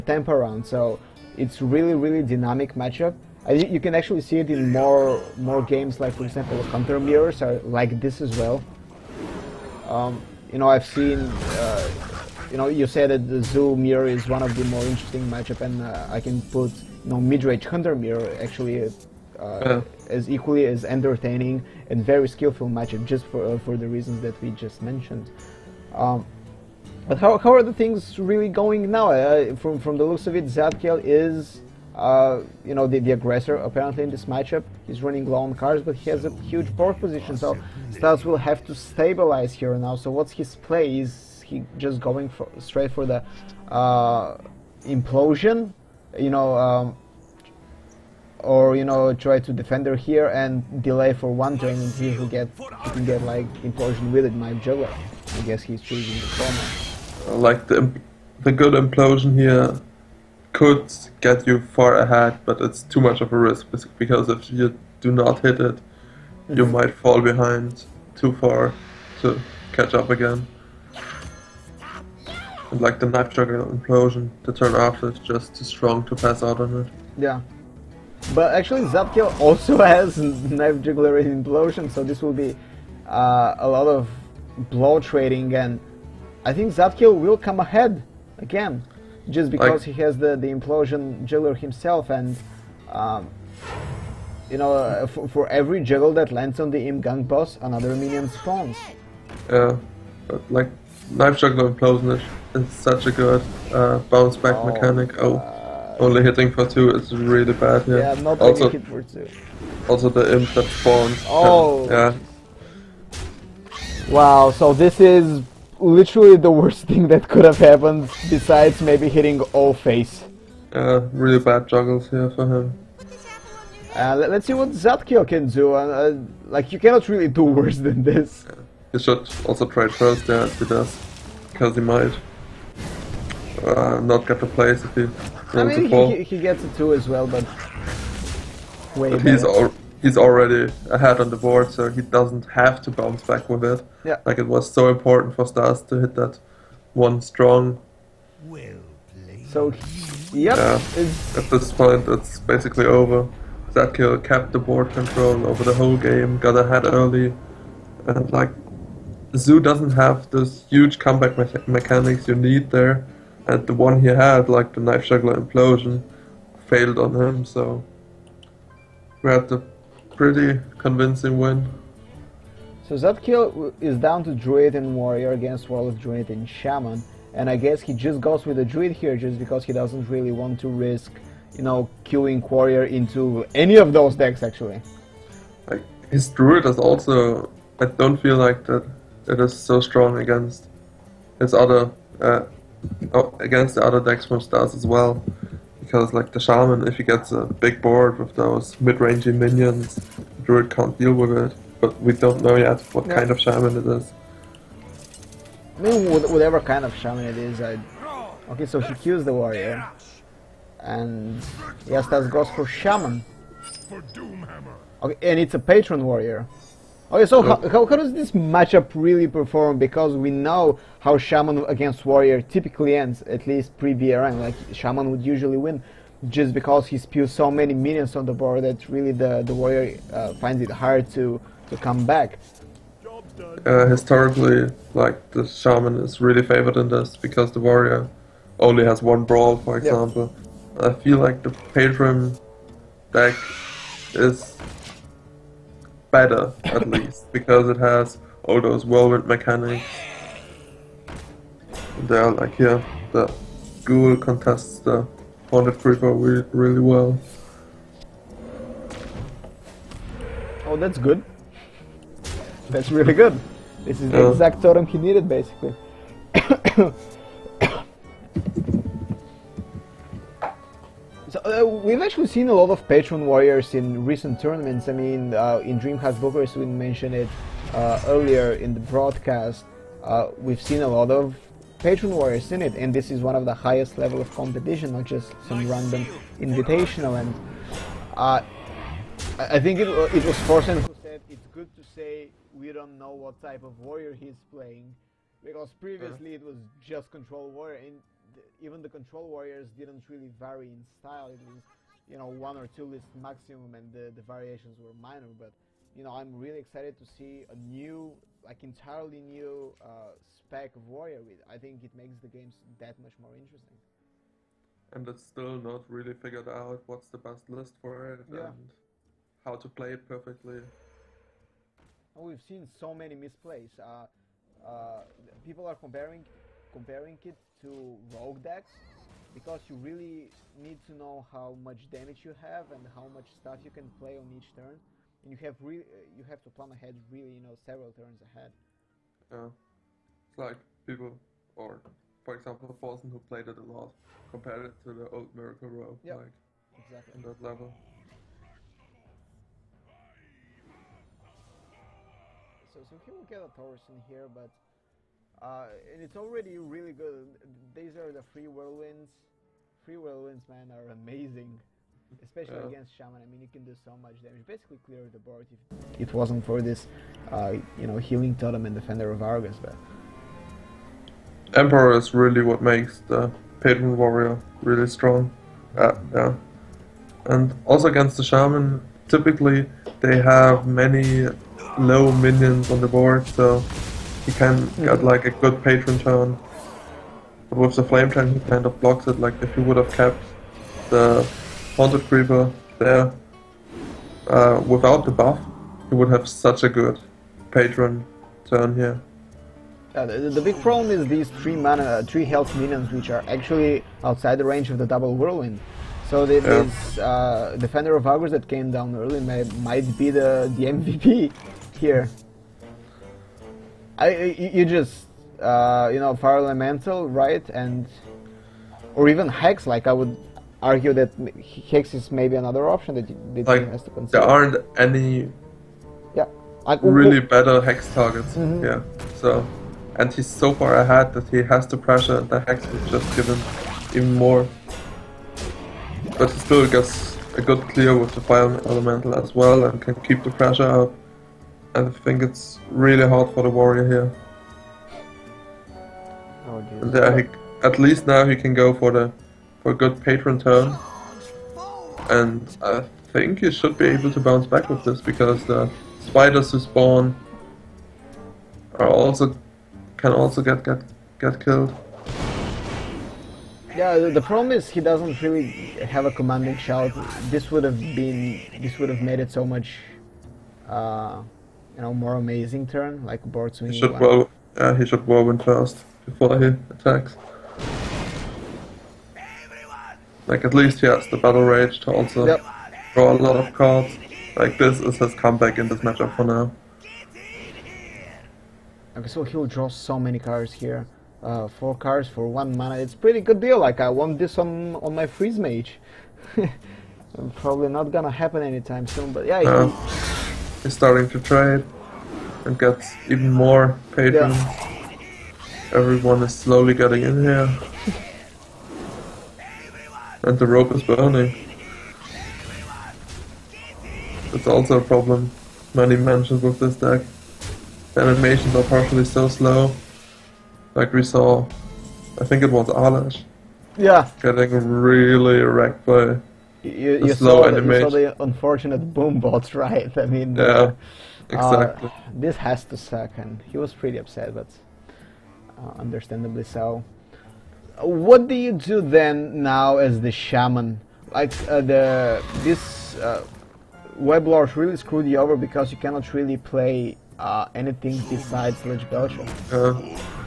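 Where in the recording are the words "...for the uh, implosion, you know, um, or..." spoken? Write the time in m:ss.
0:42.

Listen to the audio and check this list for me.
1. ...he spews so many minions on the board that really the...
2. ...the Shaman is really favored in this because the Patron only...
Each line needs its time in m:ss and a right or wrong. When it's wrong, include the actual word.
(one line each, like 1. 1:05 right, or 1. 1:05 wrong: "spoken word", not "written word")
1. 3:46 right
2. 3:55 wrong: "Warrior", not "Patron".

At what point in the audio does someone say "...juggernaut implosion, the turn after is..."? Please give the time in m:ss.
1:13.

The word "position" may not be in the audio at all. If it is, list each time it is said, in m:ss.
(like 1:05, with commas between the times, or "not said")
0:36.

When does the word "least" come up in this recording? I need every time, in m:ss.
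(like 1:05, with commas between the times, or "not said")
3:43, 4:06, 7:27, 8:00.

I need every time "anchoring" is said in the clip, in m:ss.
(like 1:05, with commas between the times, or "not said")
not said.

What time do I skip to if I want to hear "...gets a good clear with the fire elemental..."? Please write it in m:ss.
7:16.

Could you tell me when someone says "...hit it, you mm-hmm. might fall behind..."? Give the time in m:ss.
1:05.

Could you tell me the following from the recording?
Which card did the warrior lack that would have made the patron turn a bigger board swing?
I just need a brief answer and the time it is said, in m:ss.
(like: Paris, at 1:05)
Commanding Shout, at 7:46.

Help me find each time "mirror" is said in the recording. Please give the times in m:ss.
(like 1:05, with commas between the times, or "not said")
0:06, 0:13, 0:17.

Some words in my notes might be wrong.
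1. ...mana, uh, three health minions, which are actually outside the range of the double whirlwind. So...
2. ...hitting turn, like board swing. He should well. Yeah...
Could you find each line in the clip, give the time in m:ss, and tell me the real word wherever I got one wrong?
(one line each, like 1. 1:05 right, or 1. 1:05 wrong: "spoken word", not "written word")
1. 6:41 right
2. 7:52 wrong: "amazing", not "hitting".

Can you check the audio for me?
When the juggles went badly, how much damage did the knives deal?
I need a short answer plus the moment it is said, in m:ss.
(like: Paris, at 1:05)
2, at 1:45.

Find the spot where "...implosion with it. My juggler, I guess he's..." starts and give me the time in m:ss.
0:53.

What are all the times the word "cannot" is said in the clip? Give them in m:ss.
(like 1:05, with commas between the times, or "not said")
2:06, 9:05.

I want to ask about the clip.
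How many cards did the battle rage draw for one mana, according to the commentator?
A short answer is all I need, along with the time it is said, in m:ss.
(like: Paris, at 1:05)
4, at 8:11.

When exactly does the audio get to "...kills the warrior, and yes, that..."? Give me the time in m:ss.
3:28.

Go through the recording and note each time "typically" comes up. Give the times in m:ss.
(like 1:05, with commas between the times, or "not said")
3:42, 6:19.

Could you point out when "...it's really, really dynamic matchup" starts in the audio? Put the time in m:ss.
0:01.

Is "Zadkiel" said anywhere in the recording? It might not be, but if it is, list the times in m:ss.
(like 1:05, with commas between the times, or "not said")
0:30, 1:18, 1:26, 2:04, 2:33, 2:52.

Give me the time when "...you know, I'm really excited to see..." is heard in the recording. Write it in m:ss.
5:05.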